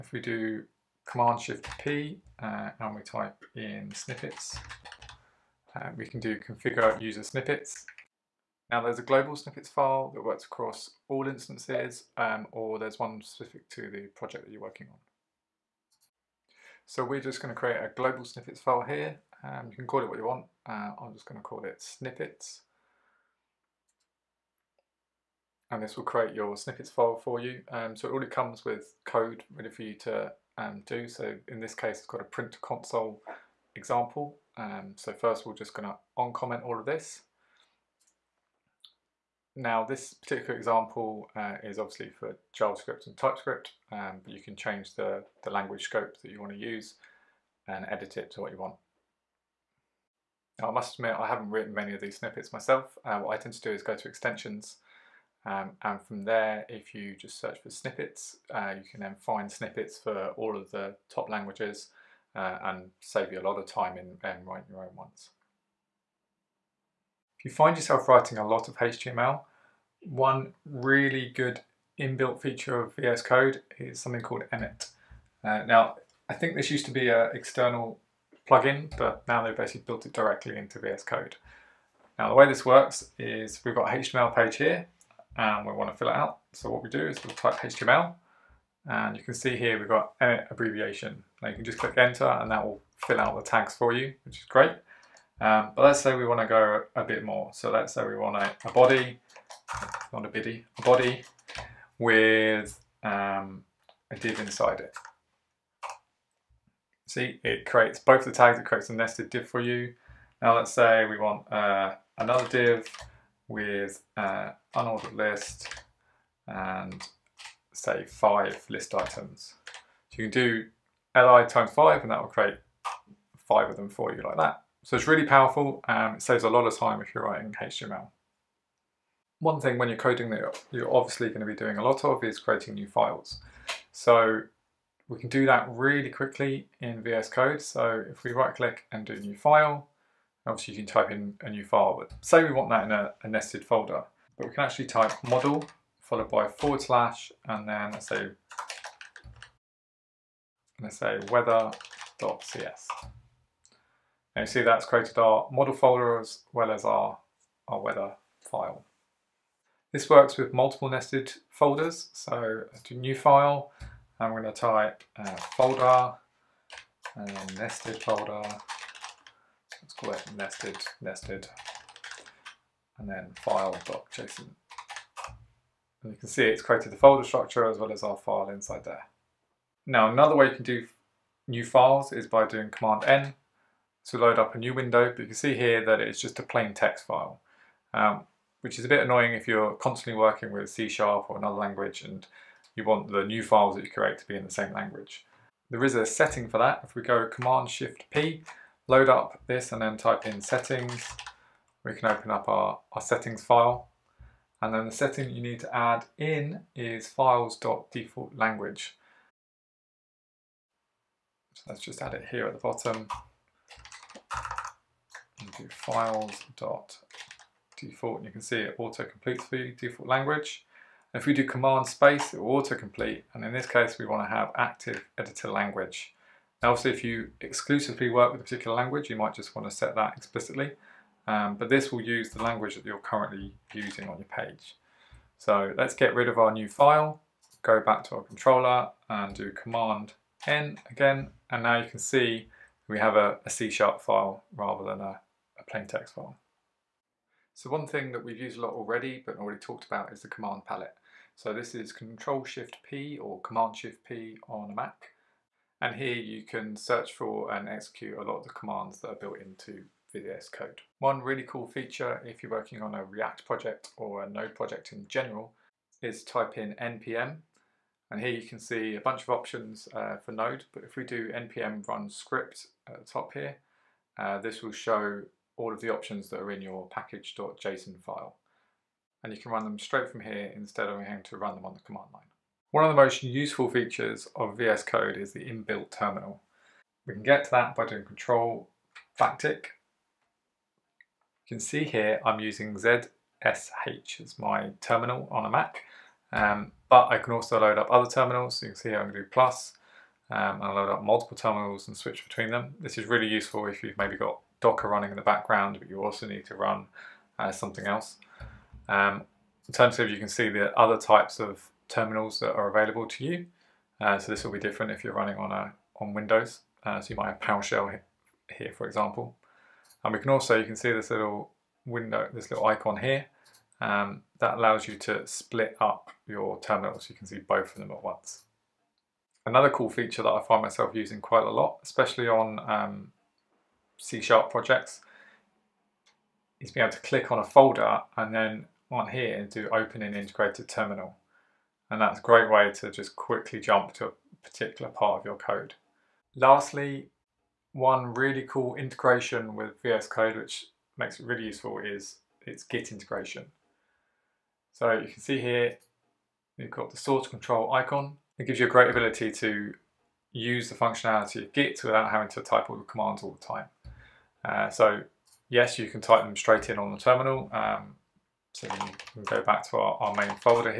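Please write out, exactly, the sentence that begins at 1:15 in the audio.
Uh, now, I think this used to be an external plugin, but now they've basically built it directly into VS Code.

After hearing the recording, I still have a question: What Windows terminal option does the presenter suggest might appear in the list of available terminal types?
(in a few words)
PowerShell.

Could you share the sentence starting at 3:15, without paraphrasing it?
There is a setting for that.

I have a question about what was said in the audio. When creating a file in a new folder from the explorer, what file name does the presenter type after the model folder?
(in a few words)
weather.cs.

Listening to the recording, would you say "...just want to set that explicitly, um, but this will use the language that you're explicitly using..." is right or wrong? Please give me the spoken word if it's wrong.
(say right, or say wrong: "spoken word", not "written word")
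wrong: "currently", not "explicitly".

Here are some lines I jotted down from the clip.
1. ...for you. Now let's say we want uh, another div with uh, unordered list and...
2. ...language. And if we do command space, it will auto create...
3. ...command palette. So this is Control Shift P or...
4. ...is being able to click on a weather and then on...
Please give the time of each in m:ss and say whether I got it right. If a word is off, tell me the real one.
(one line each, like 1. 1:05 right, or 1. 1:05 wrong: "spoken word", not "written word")
1. 1:49 right
2. 3:40 wrong: "complete", not "create"
3. 4:10 right
4. 5:36 wrong: "folder", not "weather".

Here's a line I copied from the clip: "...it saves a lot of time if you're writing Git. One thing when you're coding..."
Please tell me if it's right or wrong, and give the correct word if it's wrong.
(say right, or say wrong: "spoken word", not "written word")
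wrong: "HTML", not "Git".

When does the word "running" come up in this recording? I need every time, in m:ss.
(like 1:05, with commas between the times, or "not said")
5:04, 5:15.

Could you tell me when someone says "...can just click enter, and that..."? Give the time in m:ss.
1:31.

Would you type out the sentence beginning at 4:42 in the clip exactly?
One of the most useful features of VS Code is the inbuilt terminal.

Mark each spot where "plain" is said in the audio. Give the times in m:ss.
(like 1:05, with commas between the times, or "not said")
3:06, 4:05.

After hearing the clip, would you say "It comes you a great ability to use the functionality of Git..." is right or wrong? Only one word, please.
wrong.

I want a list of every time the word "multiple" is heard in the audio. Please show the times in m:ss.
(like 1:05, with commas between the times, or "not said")
2:40, 5:01.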